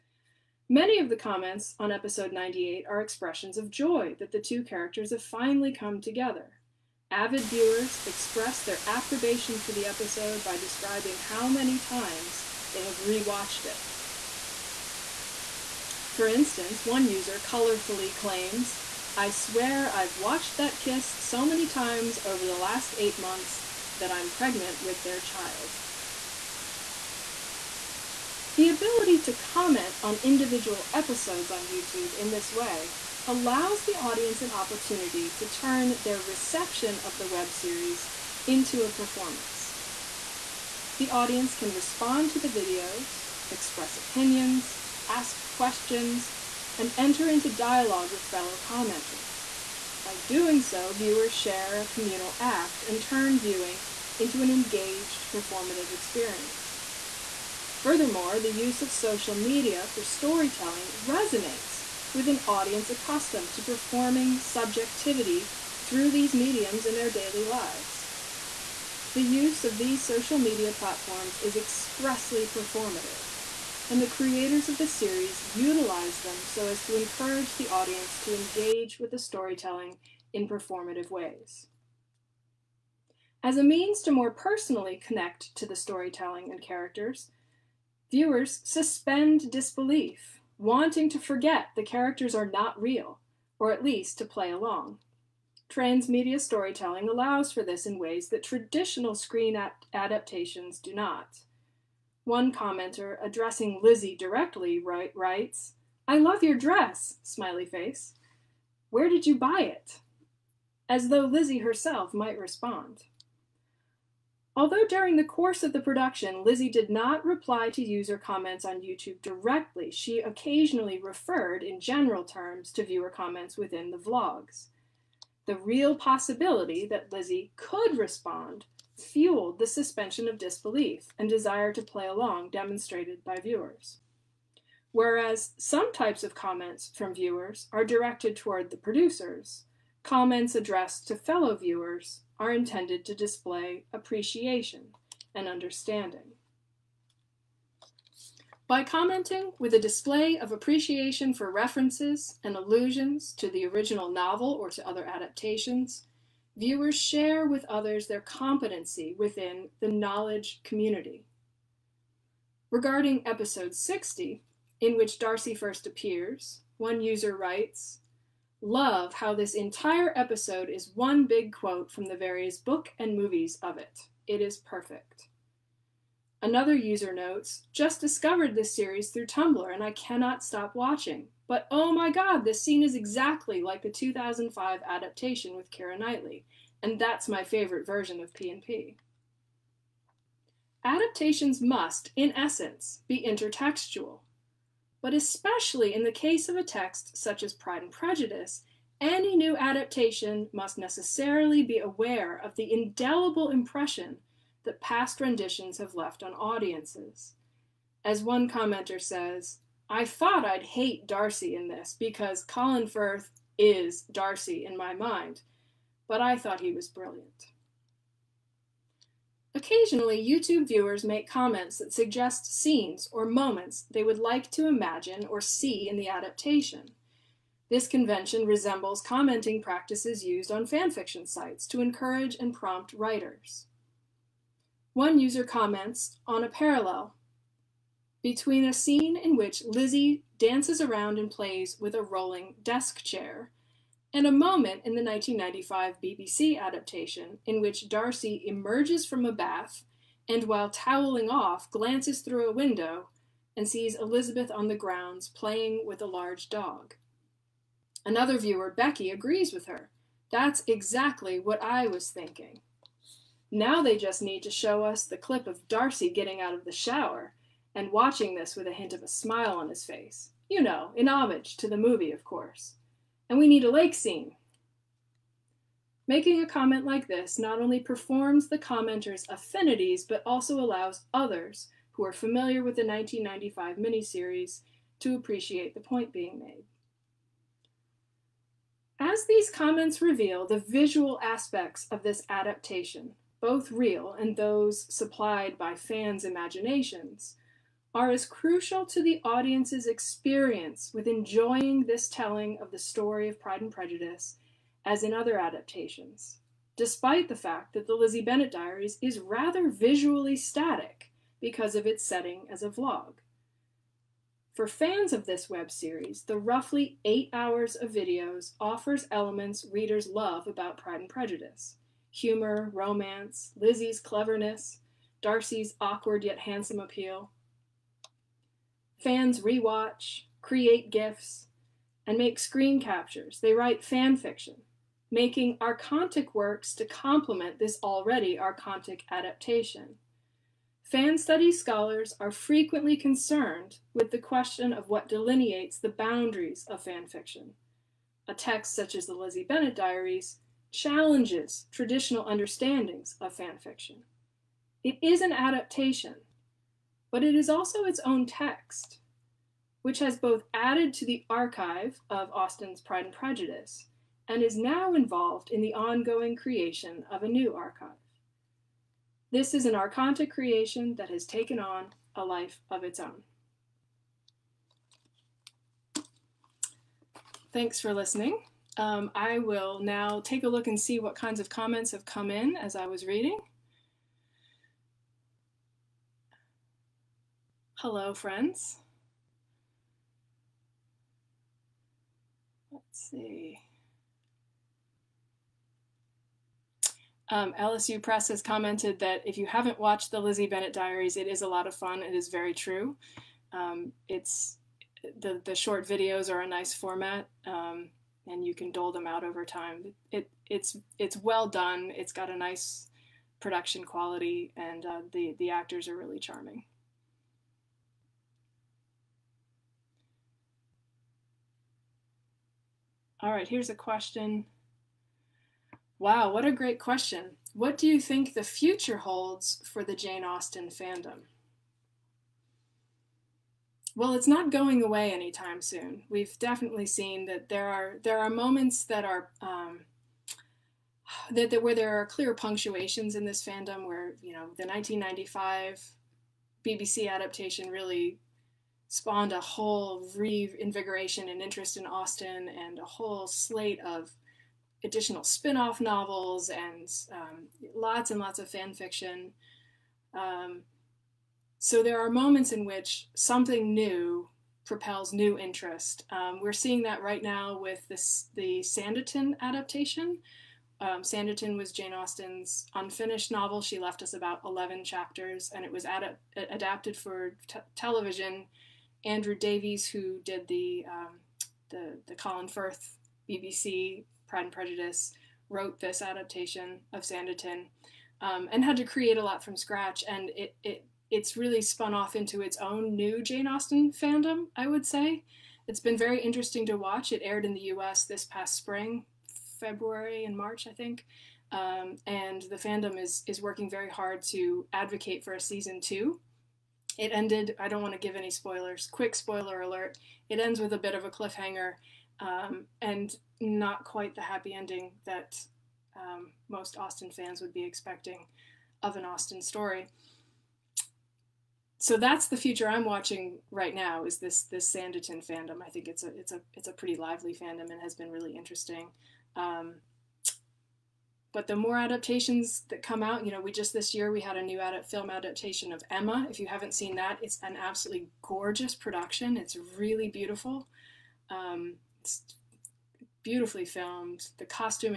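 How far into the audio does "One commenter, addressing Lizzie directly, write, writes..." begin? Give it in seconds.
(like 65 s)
102 s.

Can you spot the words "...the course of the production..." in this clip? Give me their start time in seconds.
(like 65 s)
115 s.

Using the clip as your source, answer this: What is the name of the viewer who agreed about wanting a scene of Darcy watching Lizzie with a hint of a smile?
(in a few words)
Becky.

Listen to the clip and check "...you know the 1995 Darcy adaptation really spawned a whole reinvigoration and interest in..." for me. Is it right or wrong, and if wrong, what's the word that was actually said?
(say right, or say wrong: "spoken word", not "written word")
wrong: "BBC", not "Darcy".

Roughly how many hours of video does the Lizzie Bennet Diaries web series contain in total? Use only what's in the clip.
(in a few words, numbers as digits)
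8 hours.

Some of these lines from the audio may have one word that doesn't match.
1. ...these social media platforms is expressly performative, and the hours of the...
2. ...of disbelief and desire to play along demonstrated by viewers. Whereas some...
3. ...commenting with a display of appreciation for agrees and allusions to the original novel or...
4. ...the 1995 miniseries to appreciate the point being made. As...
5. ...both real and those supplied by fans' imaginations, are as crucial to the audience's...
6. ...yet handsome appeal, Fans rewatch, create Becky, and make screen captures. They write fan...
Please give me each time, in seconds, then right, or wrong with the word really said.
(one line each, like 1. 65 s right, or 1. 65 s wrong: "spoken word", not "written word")
1. 69 s wrong: "creators", not "hours"
2. 130 s right
3. 148 s wrong: "references", not "agrees"
4. 282 s right
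5. 293 s right
6. 326 s wrong: "GIFs", not "Becky".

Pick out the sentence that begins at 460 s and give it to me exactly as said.
Um, so there are moments in which something new propels new interest.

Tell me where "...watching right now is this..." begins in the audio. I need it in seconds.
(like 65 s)
522 s.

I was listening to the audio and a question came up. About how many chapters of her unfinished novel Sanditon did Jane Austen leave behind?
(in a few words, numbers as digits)
11.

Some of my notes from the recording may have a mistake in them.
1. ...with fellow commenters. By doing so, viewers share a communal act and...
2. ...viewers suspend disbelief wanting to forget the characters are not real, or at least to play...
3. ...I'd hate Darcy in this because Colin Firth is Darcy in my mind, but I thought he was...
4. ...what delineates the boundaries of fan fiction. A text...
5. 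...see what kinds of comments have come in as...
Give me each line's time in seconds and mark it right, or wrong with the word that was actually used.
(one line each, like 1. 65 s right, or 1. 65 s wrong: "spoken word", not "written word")
1. 48 s right
2. 88 s right
3. 210 s right
4. 344 s right
5. 380 s right.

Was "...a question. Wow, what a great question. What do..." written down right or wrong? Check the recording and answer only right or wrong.
right.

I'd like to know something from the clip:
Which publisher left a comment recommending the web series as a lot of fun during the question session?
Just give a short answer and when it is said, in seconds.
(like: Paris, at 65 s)
LSU Press, at 397 s.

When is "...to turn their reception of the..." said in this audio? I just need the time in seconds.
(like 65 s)
35 s.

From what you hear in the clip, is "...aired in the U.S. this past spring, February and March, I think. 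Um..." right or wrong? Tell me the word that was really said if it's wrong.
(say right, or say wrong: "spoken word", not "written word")
right.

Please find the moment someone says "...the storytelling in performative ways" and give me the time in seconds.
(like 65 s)
79 s.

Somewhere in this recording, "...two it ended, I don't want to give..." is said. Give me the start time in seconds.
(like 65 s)
505 s.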